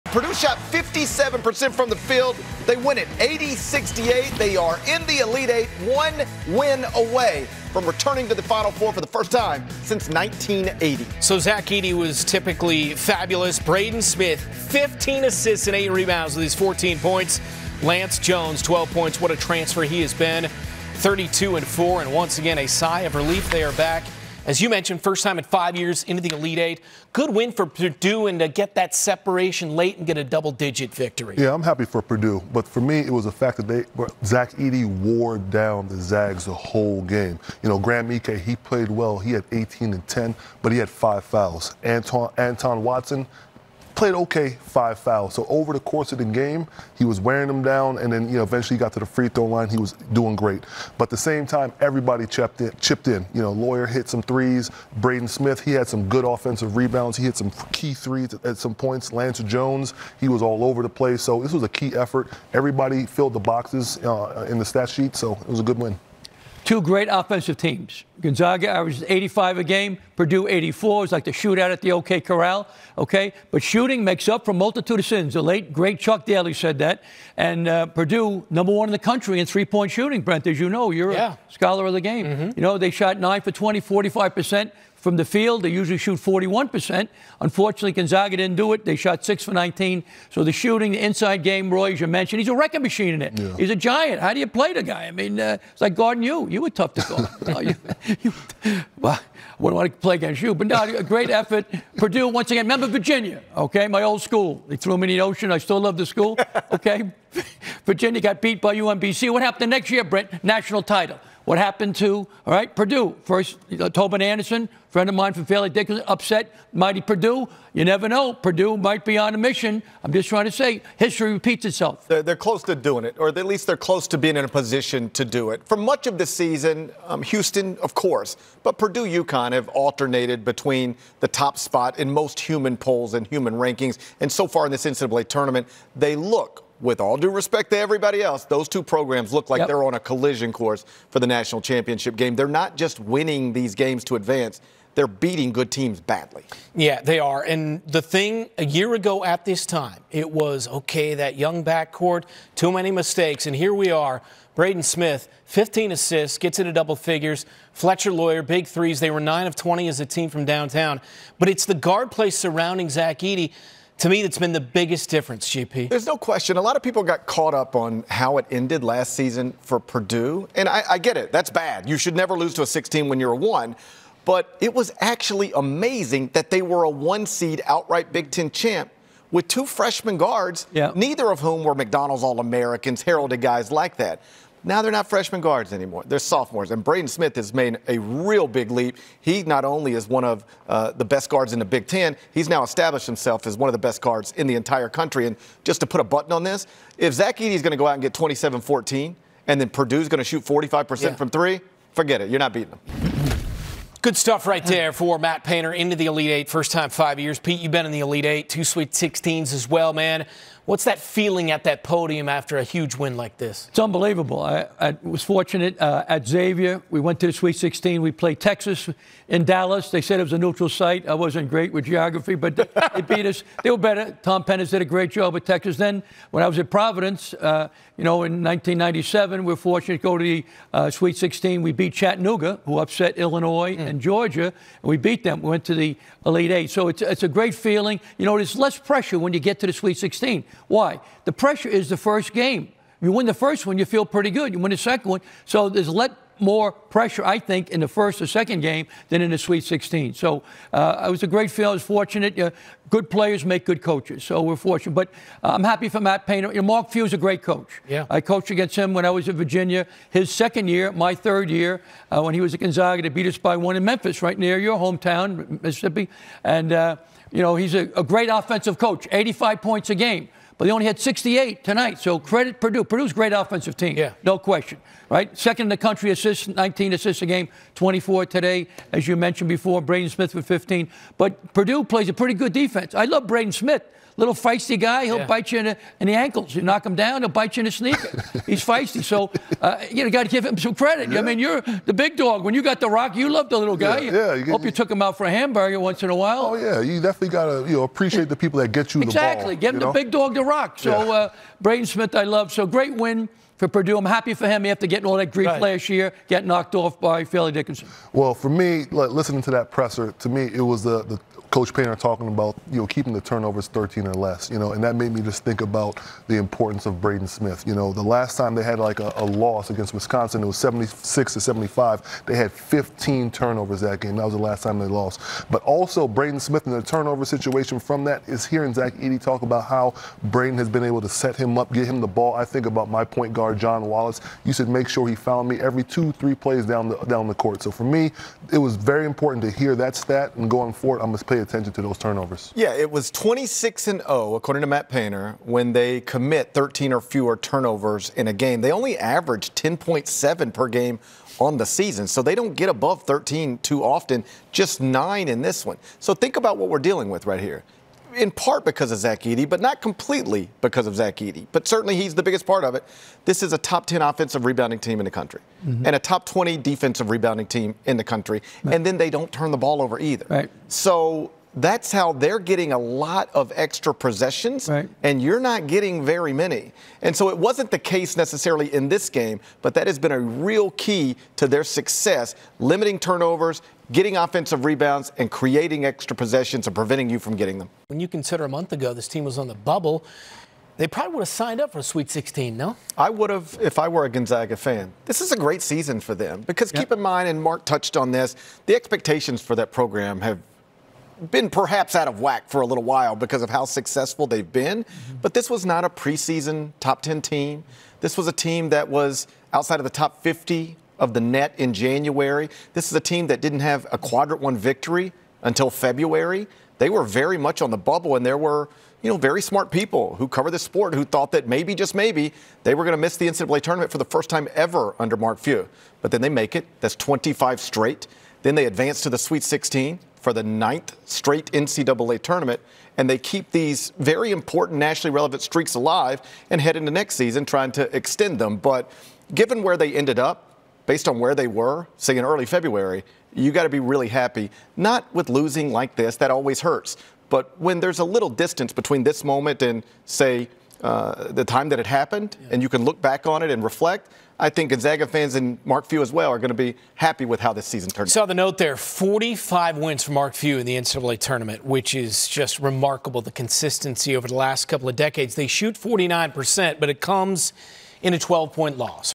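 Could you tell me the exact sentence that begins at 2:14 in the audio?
And so far in this NCAA tournament, they look with all due respect to everybody else, those two programs look like yep.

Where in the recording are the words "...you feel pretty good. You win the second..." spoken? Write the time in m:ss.
4:03.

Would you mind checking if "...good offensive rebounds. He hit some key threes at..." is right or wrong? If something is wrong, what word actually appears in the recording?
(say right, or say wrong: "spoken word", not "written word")
right.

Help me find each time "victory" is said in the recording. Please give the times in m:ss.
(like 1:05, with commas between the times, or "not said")
0:30, 6:54.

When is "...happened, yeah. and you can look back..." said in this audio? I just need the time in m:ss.
7:31.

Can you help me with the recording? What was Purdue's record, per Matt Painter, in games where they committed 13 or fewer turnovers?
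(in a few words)
26 and 0.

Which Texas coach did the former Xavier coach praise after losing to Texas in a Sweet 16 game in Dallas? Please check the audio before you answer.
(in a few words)
Tom Penders.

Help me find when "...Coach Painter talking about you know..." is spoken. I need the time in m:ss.
5:11.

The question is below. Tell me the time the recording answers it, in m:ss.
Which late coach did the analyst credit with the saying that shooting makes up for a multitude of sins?
1:15.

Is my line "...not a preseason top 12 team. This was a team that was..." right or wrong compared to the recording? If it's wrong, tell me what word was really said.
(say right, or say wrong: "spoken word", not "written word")
wrong: "10", not "12".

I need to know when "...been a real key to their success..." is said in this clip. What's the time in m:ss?
6:19.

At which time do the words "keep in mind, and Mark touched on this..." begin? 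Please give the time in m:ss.
6:36.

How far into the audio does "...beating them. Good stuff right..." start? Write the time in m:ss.
3:22.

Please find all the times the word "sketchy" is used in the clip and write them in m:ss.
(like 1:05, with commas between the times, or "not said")
not said.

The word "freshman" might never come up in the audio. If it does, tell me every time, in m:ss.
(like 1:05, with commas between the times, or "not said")
2:59, 3:05.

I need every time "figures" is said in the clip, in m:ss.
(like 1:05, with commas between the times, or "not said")
2:36.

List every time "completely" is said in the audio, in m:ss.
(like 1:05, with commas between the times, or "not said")
5:59.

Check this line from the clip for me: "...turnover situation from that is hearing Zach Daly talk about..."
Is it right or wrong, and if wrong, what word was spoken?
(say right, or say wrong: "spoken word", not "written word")
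wrong: "Edey", not "Daly".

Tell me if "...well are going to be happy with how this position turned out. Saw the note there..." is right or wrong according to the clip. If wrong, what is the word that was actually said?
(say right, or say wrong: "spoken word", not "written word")
wrong: "season", not "position".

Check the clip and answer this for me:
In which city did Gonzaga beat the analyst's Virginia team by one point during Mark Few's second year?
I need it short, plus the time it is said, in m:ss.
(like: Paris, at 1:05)
Memphis, at 4:23.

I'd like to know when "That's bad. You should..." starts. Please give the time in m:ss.
2:51.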